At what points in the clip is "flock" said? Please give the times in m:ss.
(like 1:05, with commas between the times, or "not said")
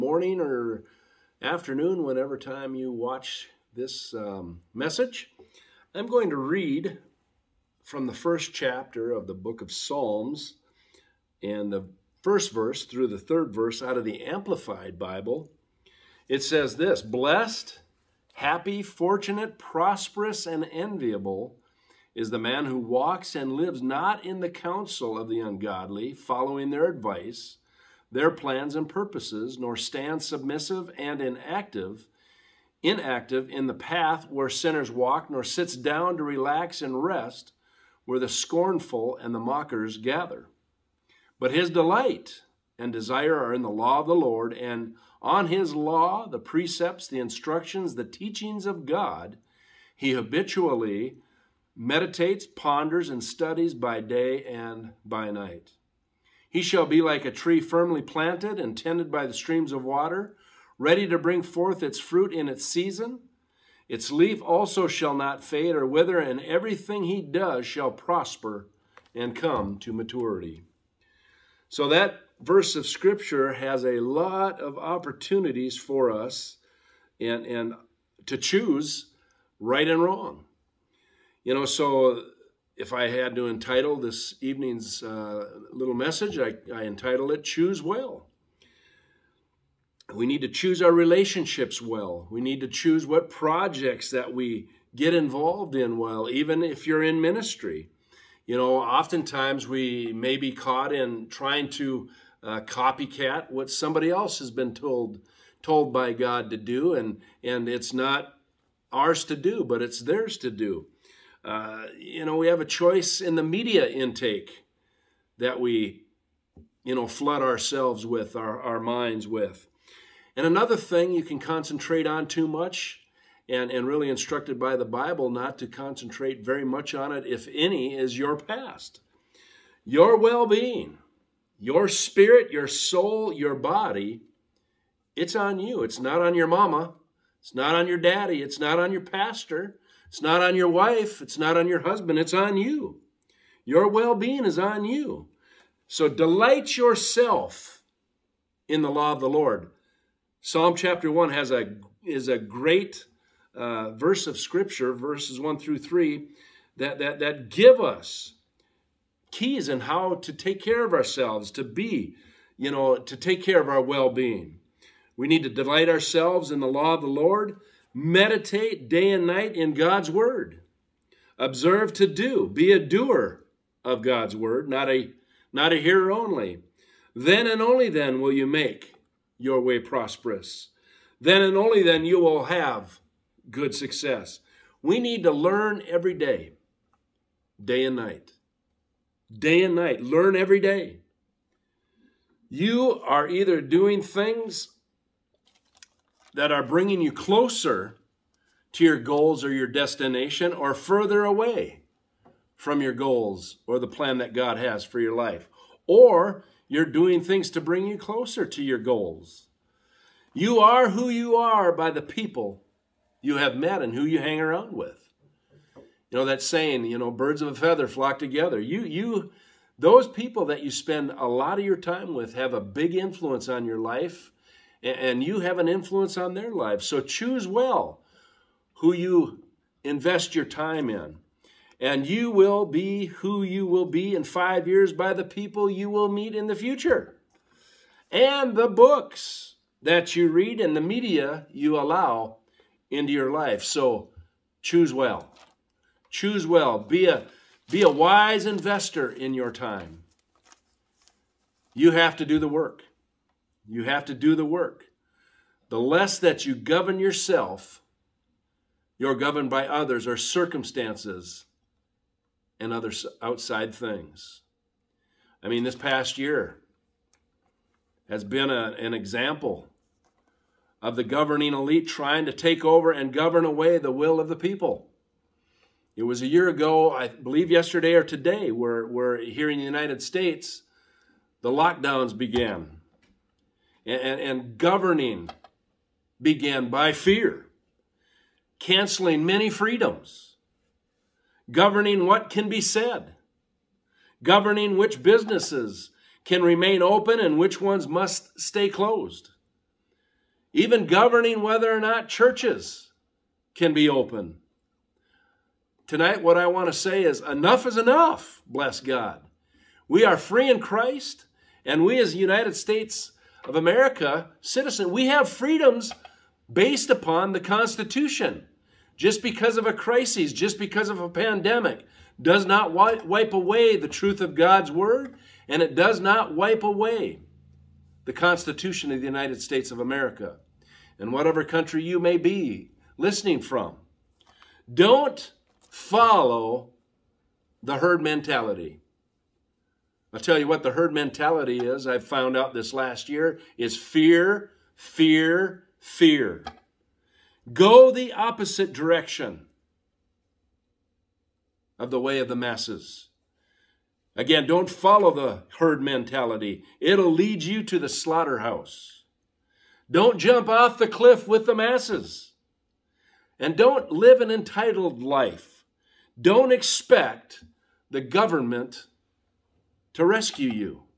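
3:37.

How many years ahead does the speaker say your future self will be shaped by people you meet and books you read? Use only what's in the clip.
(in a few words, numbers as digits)
5.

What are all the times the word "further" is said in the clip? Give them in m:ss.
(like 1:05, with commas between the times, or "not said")
3:20.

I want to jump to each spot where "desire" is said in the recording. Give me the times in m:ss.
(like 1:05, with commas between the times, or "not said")
0:42.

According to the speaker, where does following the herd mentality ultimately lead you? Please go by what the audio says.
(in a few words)
The slaughterhouse.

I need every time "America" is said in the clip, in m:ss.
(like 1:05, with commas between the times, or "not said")
5:13, 5:29.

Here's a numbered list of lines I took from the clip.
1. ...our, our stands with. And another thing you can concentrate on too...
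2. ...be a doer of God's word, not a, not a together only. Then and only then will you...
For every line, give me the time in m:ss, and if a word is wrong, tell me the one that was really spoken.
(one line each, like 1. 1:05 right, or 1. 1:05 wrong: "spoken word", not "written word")
1. 1:58 wrong: "minds", not "stands"
2. 2:52 wrong: "hearer", not "together".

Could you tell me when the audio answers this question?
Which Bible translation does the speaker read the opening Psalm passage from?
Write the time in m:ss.
0:14.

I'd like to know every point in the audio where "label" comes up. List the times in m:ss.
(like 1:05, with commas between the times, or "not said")
not said.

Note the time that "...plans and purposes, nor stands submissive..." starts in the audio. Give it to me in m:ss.
0:28.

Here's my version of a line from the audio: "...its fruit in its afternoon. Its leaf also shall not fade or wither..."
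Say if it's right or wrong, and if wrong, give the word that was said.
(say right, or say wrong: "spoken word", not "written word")
wrong: "season", not "afternoon".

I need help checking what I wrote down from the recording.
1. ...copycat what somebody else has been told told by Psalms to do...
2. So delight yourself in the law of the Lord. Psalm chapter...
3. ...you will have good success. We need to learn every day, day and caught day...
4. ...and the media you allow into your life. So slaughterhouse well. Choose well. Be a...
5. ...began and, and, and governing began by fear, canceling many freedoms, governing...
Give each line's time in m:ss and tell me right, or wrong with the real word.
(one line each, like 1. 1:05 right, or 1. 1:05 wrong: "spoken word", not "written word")
1. 1:42 wrong: "God", not "Psalms"
2. 2:25 right
3. 3:02 wrong: "night", not "caught"
4. 4:00 wrong: "choose", not "slaughterhouse"
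5. 4:42 right.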